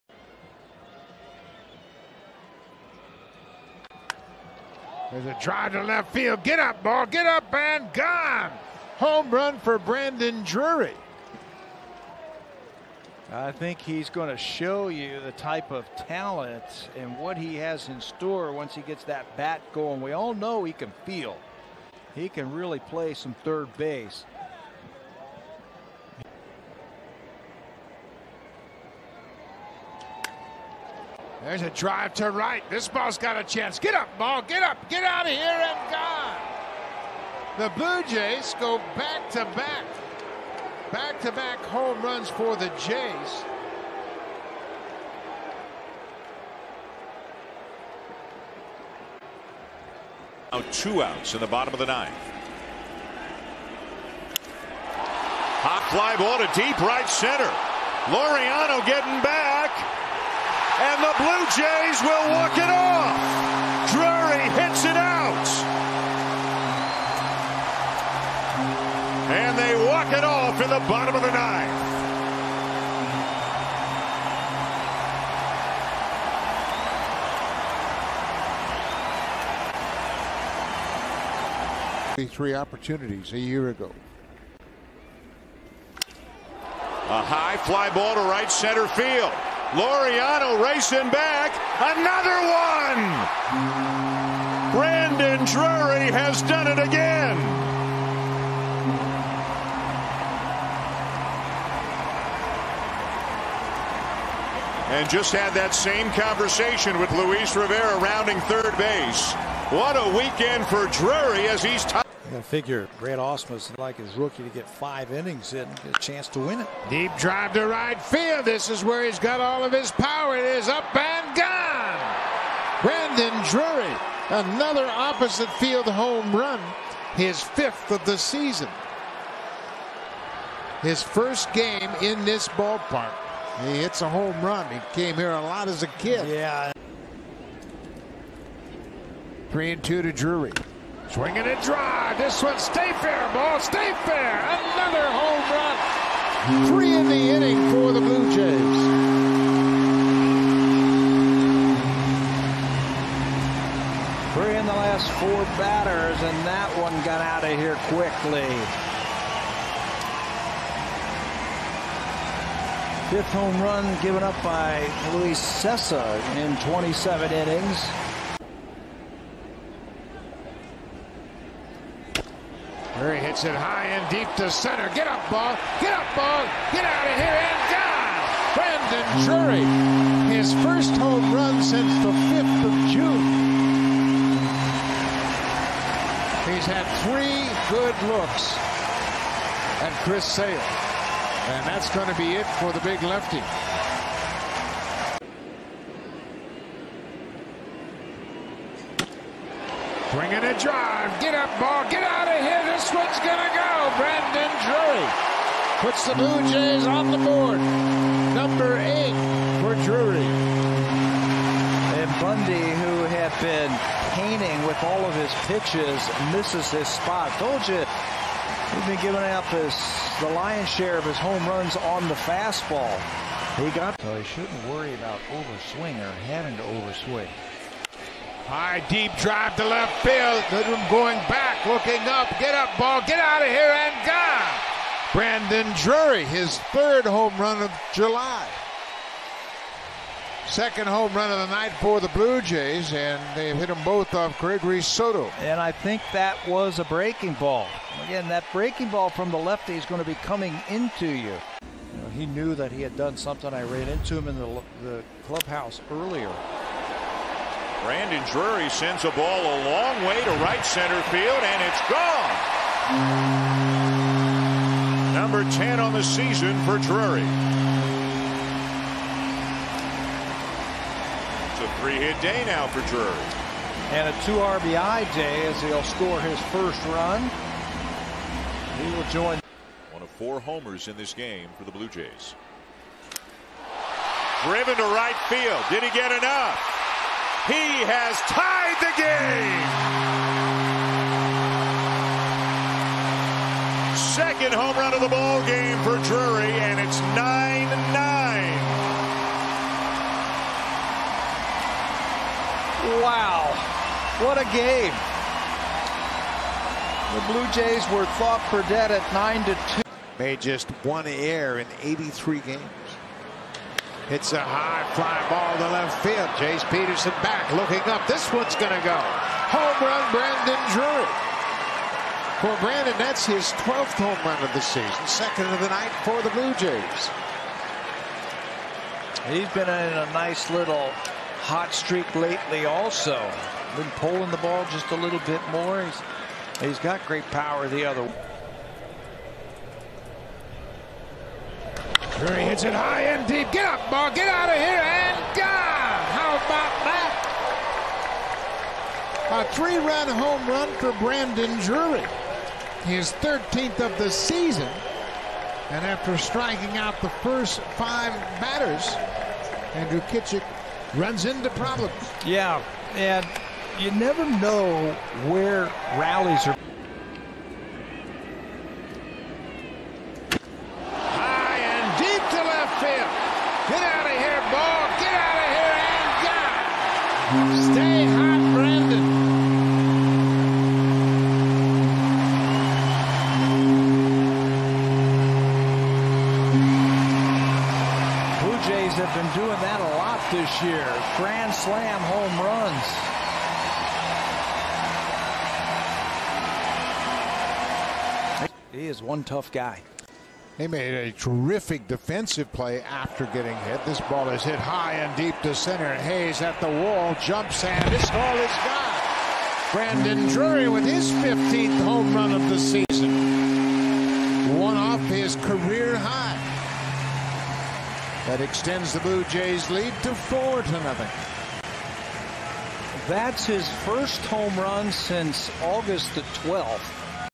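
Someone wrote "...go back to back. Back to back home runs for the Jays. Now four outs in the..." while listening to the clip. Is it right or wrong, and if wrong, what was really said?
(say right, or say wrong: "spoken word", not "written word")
wrong: "two", not "four".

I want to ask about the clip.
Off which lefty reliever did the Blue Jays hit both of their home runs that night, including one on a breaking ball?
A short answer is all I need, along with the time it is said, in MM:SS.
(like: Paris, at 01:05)
Gregory Soto, at 04:04.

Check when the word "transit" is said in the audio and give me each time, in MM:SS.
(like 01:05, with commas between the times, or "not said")
not said.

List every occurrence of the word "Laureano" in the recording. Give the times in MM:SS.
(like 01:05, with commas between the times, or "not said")
00:58, 01:29.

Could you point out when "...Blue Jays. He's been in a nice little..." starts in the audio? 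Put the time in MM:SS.
05:26.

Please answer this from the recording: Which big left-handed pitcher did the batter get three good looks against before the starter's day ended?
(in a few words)
Chris Sale.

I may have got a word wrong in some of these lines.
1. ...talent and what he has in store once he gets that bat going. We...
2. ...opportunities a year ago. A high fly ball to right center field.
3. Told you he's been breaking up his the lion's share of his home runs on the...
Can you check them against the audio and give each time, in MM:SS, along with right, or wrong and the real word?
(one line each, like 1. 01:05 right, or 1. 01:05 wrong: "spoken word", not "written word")
1. 00:15 right
2. 01:22 right
3. 03:37 wrong: "giving", not "breaking".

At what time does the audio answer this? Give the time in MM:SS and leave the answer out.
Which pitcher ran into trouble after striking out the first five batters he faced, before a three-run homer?
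05:59.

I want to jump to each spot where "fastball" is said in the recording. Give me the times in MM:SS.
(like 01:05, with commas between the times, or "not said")
03:42.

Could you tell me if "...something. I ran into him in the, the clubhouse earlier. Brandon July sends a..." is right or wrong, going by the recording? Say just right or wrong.
wrong.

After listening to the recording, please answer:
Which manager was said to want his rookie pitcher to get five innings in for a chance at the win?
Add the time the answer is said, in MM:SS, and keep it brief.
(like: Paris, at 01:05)
Brad Ausmus, at 01:52.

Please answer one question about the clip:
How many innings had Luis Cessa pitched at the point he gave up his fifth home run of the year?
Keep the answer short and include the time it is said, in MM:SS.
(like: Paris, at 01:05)
27, at 02:46.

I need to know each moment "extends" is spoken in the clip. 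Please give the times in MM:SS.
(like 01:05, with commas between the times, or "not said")
06:58.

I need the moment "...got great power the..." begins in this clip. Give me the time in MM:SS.
05:36.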